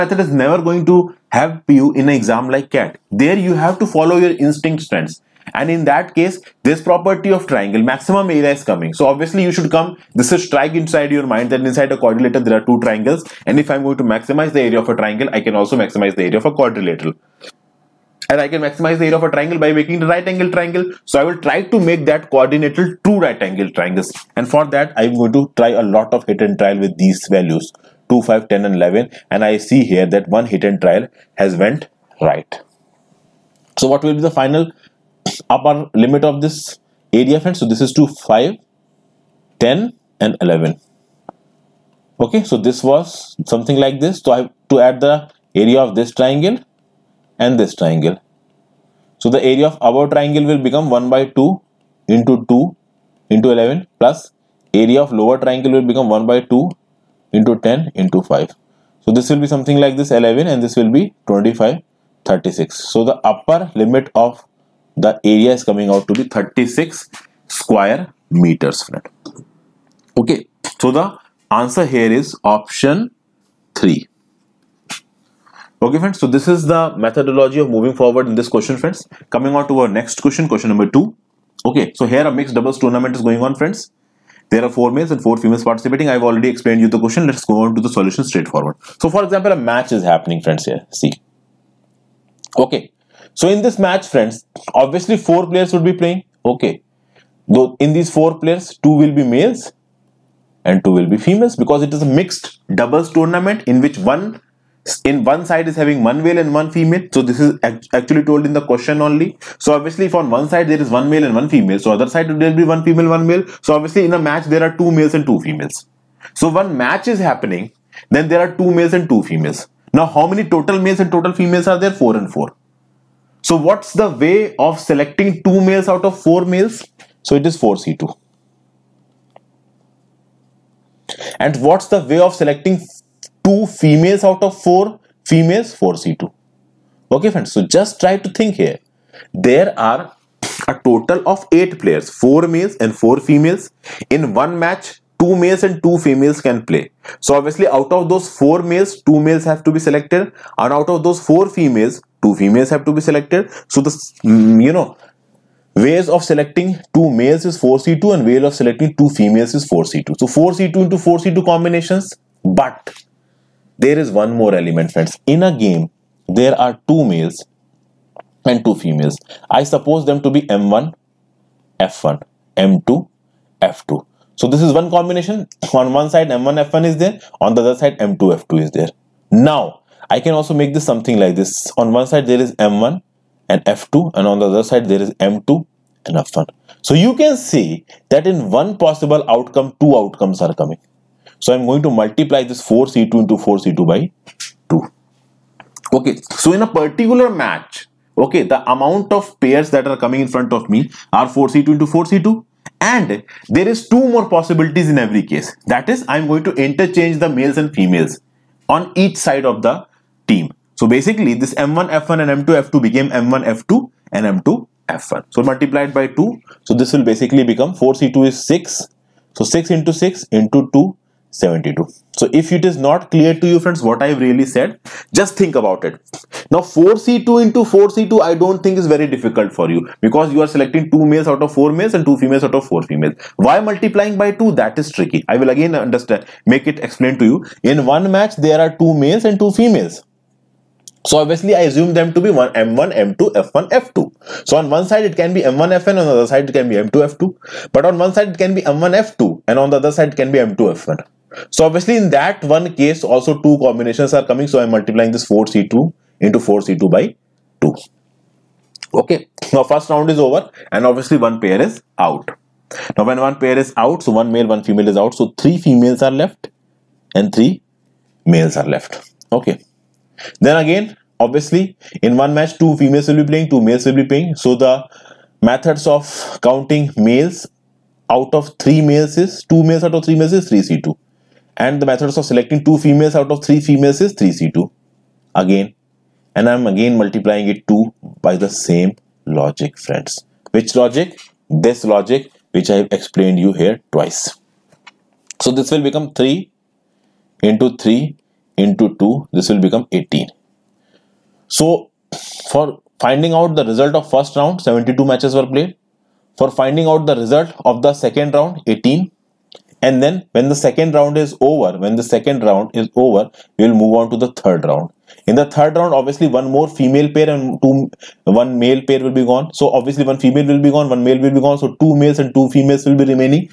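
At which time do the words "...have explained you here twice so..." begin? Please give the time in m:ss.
4:52.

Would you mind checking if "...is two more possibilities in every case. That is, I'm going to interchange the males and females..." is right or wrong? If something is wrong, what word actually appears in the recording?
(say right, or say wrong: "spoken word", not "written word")
right.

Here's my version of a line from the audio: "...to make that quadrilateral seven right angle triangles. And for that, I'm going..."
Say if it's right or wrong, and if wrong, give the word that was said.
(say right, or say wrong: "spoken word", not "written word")
wrong: "two", not "seven".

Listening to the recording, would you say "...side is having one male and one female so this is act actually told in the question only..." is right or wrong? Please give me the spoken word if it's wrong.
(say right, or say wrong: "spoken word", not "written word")
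right.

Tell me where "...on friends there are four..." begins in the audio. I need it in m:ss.
1:23.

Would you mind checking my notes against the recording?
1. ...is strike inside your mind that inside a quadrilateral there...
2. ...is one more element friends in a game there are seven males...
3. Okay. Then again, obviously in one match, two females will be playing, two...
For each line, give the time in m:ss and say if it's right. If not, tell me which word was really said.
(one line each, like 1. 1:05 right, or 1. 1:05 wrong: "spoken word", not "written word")
1. 0:10 right
2. 2:44 wrong: "two", not "seven"
3. 4:29 right.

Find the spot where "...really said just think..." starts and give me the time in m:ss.
3:44.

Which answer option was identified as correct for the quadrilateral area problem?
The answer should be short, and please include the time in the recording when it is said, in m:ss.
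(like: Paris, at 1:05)
option 3, at 1:12.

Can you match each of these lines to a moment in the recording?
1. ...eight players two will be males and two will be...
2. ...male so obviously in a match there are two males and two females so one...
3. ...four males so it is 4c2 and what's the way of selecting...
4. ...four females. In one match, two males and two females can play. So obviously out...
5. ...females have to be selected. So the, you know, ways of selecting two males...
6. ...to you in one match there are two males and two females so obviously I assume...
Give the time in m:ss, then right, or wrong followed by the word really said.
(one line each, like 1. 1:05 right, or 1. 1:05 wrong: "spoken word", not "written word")
1. 1:38 wrong: "four", not "eight"
2. 1:53 right
3. 2:06 right
4. 2:22 right
5. 2:32 right
6. 3:57 right.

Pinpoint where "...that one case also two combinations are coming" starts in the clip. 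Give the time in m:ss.
4:12.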